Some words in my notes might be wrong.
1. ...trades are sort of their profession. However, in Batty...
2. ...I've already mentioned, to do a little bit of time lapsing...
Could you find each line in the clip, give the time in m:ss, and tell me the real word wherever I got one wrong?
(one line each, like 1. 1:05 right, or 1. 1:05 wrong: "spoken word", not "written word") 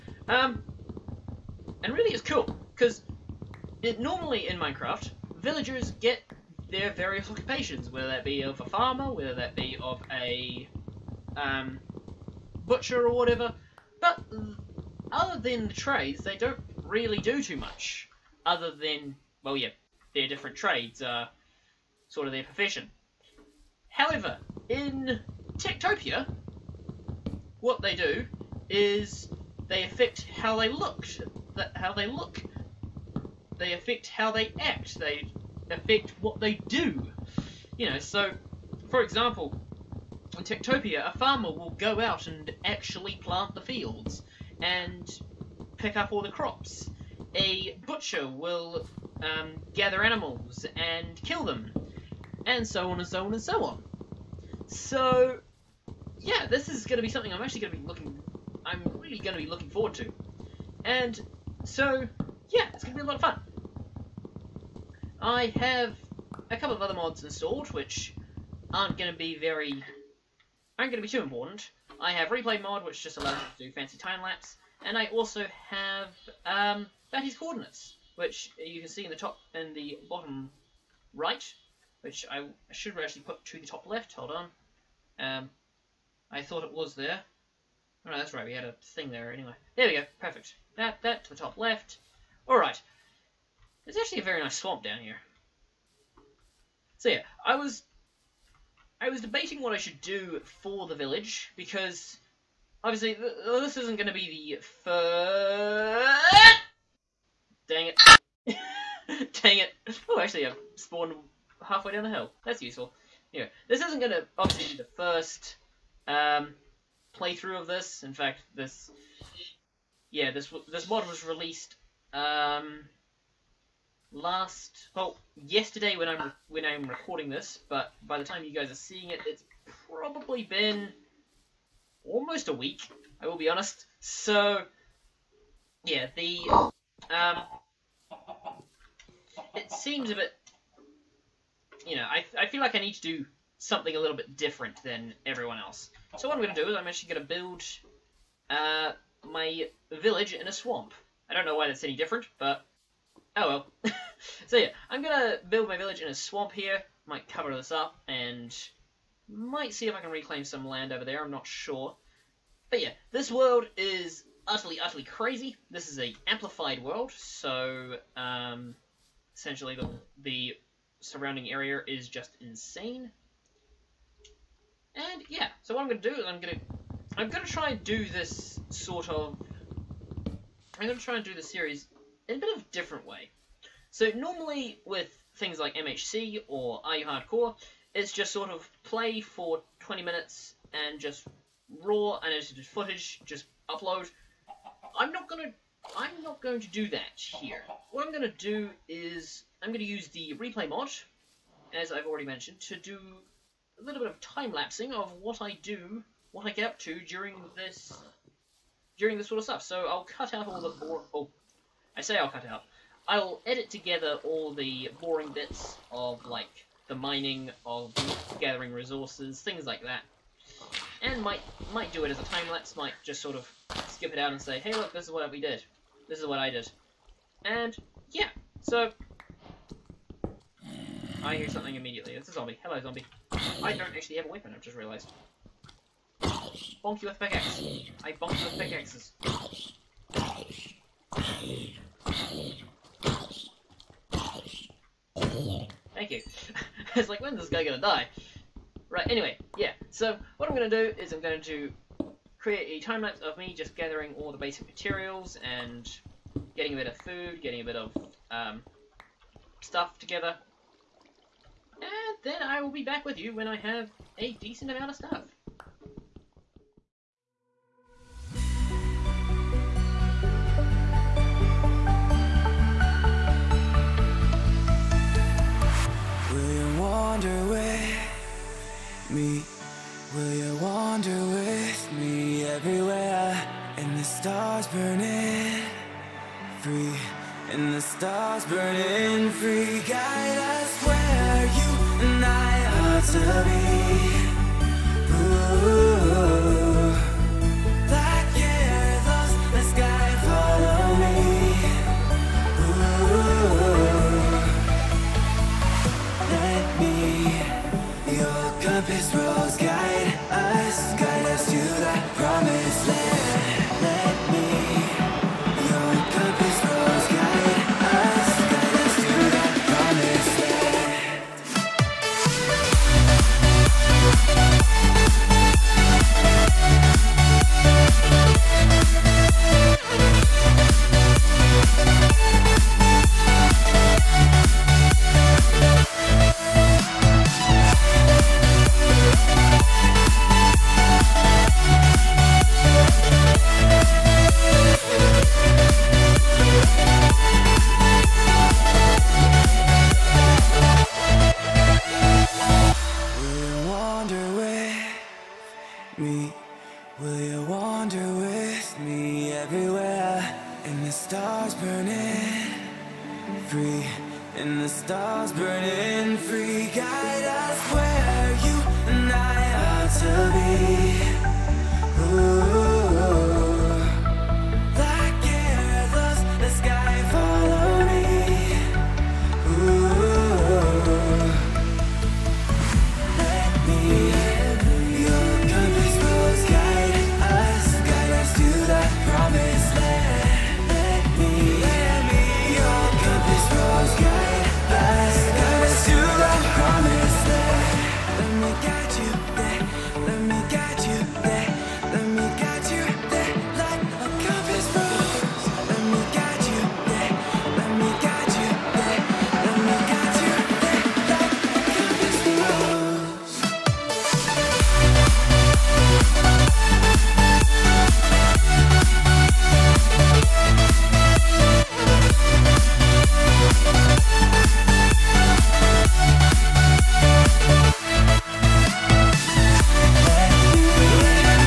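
1. 0:20 wrong: "TekTopia", not "Batty"
2. 3:21 right.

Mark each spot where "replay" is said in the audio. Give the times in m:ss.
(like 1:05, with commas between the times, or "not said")
1:12, 3:20.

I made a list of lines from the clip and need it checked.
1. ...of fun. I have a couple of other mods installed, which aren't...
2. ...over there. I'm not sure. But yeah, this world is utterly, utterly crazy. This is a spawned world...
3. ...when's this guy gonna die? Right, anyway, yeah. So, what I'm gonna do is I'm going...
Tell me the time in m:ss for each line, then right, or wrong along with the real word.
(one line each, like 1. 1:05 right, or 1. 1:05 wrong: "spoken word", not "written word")
1. 1:03 right
2. 2:40 wrong: "amplified", not "spawned"
3. 4:07 right.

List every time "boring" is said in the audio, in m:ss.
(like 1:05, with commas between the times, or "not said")
3:30, 3:35.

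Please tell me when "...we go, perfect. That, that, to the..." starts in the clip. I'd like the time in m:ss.
1:29.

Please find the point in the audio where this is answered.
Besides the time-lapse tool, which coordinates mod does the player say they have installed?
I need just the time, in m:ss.
1:17.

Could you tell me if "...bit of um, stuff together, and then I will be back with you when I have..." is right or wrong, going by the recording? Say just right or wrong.
right.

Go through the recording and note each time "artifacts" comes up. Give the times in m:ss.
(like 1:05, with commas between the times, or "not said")
not said.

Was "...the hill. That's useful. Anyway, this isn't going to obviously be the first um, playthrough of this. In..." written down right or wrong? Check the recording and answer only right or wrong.
right.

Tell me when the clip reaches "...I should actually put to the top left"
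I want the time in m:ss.
1:22.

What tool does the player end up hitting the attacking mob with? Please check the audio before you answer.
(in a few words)
Pickaxe.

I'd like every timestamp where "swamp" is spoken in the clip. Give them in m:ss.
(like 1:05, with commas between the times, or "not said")
1:34, 2:30, 2:36.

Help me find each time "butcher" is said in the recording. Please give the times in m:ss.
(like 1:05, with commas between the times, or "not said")
0:12, 0:47.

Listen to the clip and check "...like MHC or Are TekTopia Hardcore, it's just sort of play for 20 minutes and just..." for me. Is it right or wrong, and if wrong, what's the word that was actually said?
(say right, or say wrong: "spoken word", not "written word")
wrong: "You", not "TekTopia".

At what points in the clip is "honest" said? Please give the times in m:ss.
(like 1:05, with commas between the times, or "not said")
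2:13.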